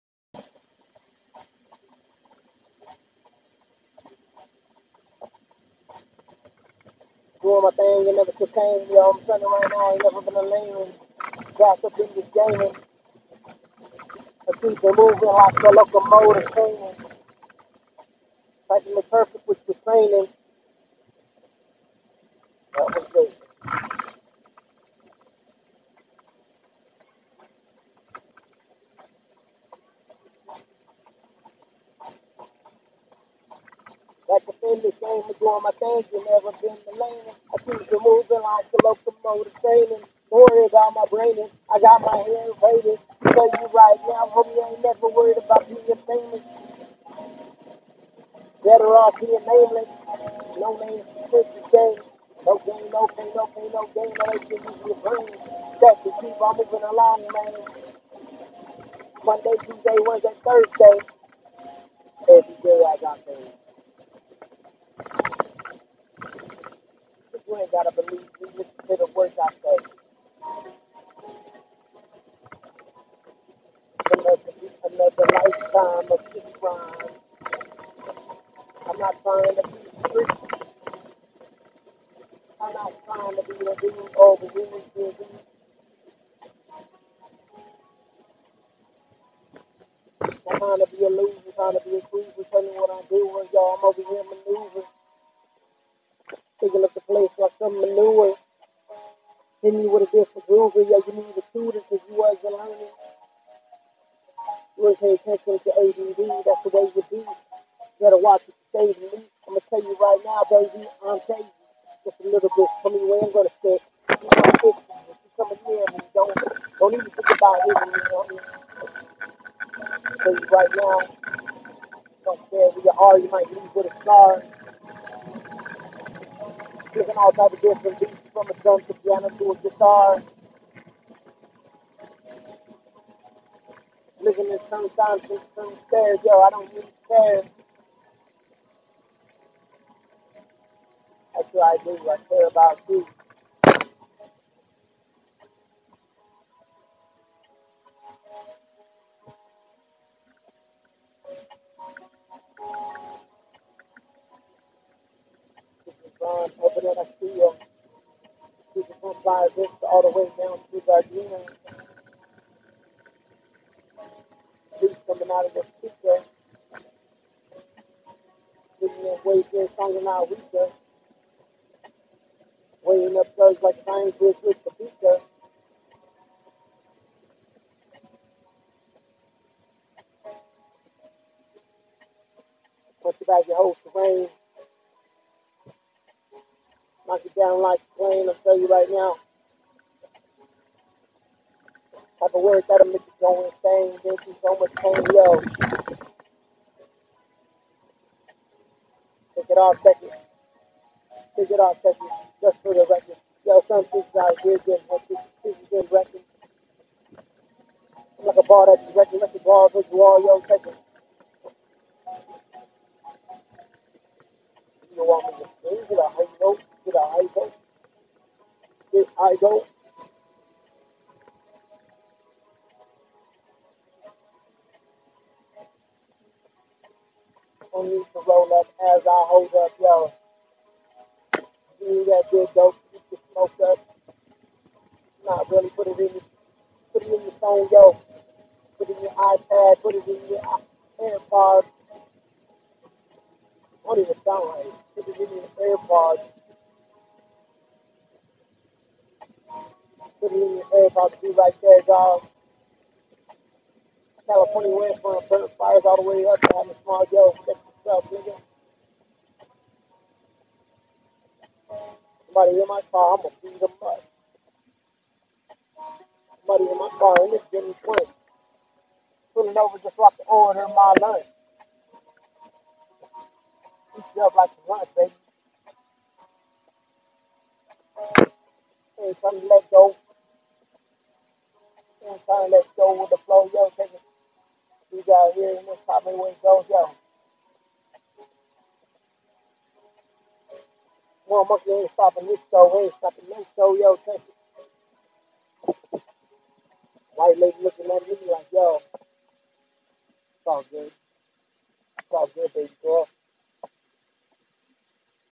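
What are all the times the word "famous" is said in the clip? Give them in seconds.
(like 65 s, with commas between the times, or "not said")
45 s.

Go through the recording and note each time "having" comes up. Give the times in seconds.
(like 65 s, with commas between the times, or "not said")
256 s.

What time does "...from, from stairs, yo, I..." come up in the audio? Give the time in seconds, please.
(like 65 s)
135 s.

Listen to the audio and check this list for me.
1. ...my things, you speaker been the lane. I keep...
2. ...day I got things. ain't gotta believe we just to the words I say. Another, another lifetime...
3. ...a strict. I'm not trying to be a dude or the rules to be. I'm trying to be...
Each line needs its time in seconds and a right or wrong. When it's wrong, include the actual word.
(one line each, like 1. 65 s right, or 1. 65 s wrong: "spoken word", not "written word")
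1. 35 s wrong: "never", not "speaker"
2. 62 s right
3. 79 s right.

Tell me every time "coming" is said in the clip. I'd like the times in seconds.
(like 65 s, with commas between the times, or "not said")
115 s, 165 s.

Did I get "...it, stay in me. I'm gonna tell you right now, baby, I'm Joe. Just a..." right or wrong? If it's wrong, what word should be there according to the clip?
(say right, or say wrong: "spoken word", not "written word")
wrong: "Daisy", not "Joe".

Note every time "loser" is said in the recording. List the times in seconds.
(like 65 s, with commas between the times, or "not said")
91 s.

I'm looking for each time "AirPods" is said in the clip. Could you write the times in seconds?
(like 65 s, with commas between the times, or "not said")
240 s, 245 s.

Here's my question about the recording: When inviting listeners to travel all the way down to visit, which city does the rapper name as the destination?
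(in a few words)
Gardena.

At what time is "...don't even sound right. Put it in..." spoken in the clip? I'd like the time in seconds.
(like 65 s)
243 s.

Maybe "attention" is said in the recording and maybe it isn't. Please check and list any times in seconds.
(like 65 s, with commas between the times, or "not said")
105 s.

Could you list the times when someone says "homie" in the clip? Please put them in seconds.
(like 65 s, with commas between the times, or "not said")
44 s.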